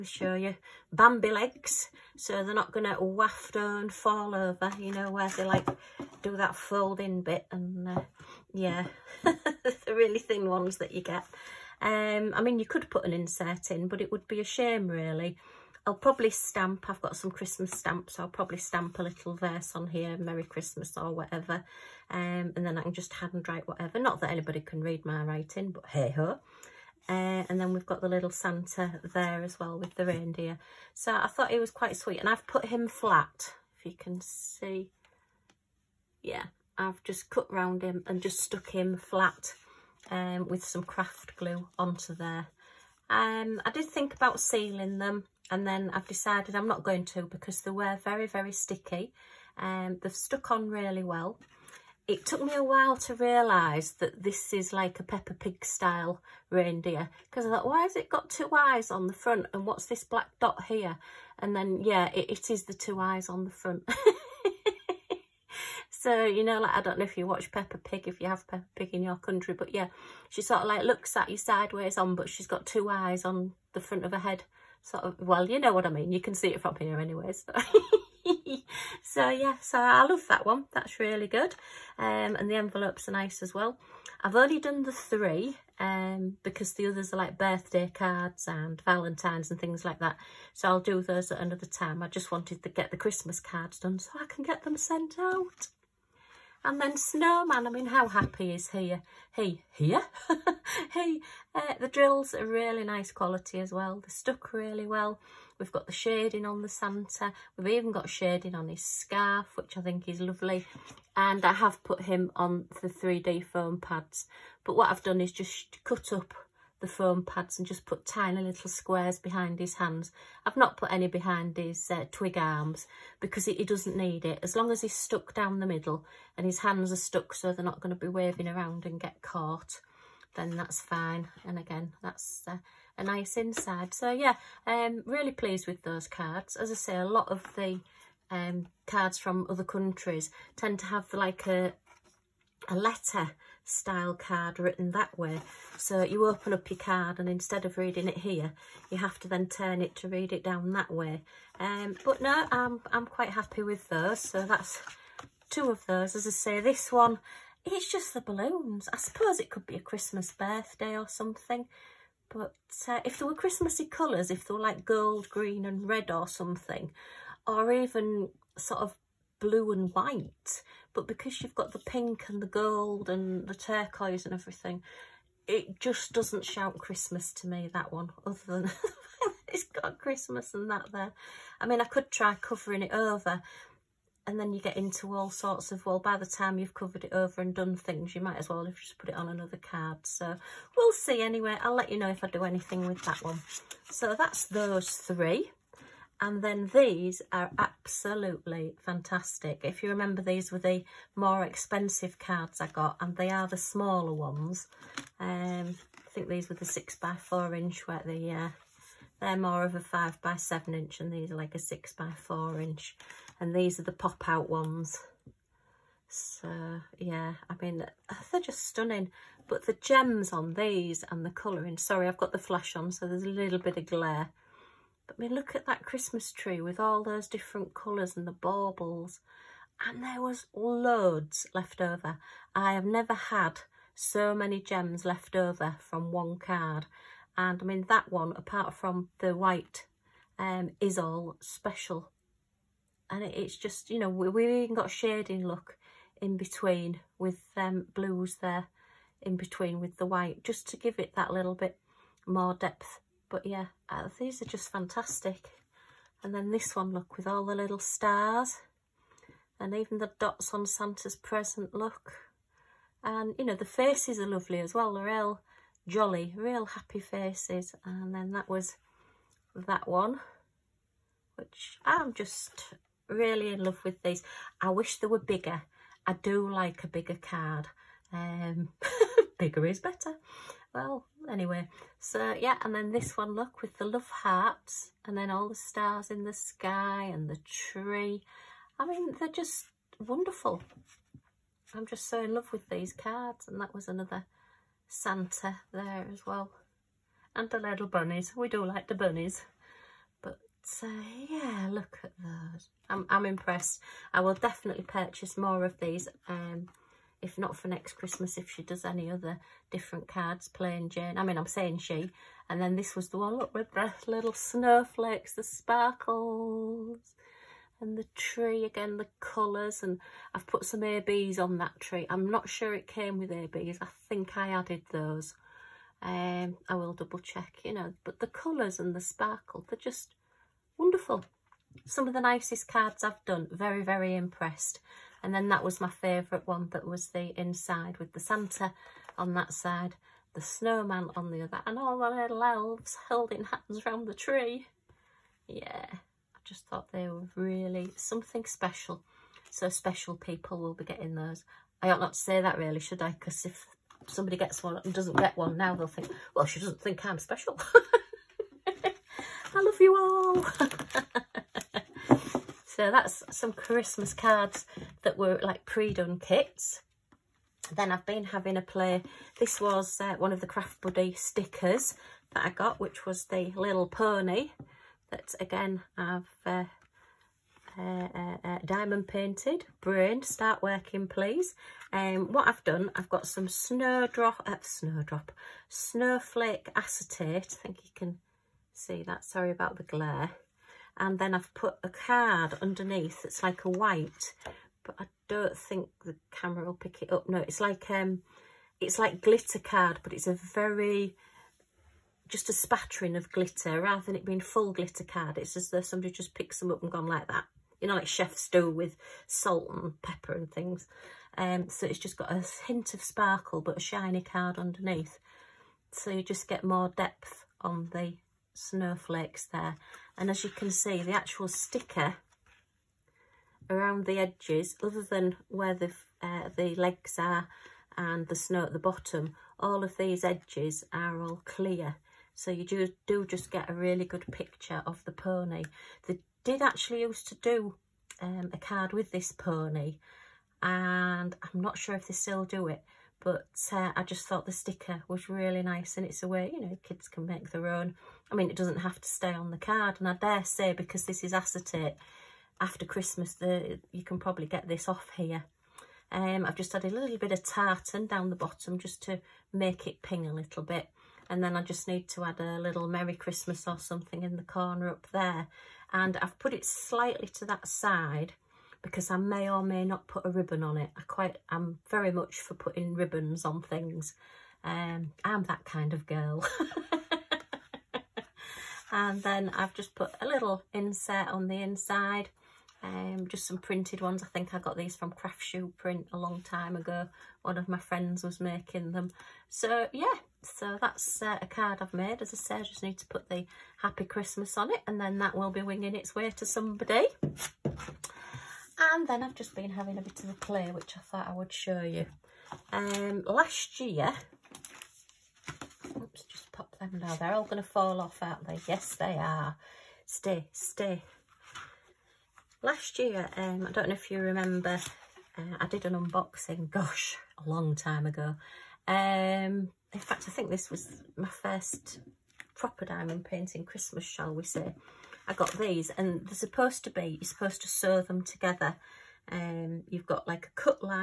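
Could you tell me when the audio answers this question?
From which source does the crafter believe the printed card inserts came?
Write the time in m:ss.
8:05.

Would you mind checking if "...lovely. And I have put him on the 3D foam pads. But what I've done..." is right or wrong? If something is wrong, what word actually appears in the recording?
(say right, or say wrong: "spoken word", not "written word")
right.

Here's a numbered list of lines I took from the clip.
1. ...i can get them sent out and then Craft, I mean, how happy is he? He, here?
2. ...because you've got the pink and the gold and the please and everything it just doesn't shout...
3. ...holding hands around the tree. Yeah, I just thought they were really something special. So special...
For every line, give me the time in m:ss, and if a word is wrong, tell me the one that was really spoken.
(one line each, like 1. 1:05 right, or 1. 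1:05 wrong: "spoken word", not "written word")
1. 1:34 wrong: "Snowman", not "Craft"
2. 2:51 wrong: "turquoise", not "please"
3. 5:43 right.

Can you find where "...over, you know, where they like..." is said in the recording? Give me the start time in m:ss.
0:04.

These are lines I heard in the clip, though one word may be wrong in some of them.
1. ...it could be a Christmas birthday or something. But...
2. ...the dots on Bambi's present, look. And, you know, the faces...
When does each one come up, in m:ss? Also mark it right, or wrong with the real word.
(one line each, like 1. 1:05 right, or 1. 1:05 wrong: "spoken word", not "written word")
1. 2:39 right
2. 4:19 wrong: "Santa", not "Bambi".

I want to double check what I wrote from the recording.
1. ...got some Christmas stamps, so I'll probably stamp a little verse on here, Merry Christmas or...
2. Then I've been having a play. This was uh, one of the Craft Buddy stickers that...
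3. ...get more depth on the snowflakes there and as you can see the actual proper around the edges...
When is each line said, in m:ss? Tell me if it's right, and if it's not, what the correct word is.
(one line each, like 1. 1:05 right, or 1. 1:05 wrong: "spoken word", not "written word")
1. 0:17 right
2. 6:07 right
3. 6:56 wrong: "sticker", not "proper".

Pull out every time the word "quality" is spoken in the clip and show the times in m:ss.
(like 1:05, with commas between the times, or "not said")
1:43.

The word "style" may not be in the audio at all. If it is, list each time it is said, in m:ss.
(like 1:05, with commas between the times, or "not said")
0:55, 2:23.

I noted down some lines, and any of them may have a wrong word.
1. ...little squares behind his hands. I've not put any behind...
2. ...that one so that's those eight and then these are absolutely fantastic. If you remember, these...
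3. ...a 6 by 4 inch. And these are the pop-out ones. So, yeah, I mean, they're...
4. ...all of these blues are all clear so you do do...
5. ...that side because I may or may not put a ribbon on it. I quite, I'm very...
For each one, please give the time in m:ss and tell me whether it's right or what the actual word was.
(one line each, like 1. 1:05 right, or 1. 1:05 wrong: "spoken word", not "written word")
1. 1:58 right
2. 3:13 wrong: "three", not "eight"
3. 3:31 right
4. 7:09 wrong: "edges", not "blues"
5. 7:47 right.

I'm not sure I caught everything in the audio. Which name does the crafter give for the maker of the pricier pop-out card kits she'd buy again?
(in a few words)
Pink Jane.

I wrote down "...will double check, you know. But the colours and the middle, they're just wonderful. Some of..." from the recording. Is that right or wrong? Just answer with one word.
wrong.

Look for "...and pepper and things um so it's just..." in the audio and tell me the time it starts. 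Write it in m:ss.
6:49.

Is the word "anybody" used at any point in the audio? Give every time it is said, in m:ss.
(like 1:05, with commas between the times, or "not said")
0:24.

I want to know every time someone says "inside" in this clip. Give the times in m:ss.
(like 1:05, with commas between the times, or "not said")
2:13, 5:37, 8:01.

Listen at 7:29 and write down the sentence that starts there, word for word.
And I dare say, because this is acetate, after Christmas, the, you can probably get this off here.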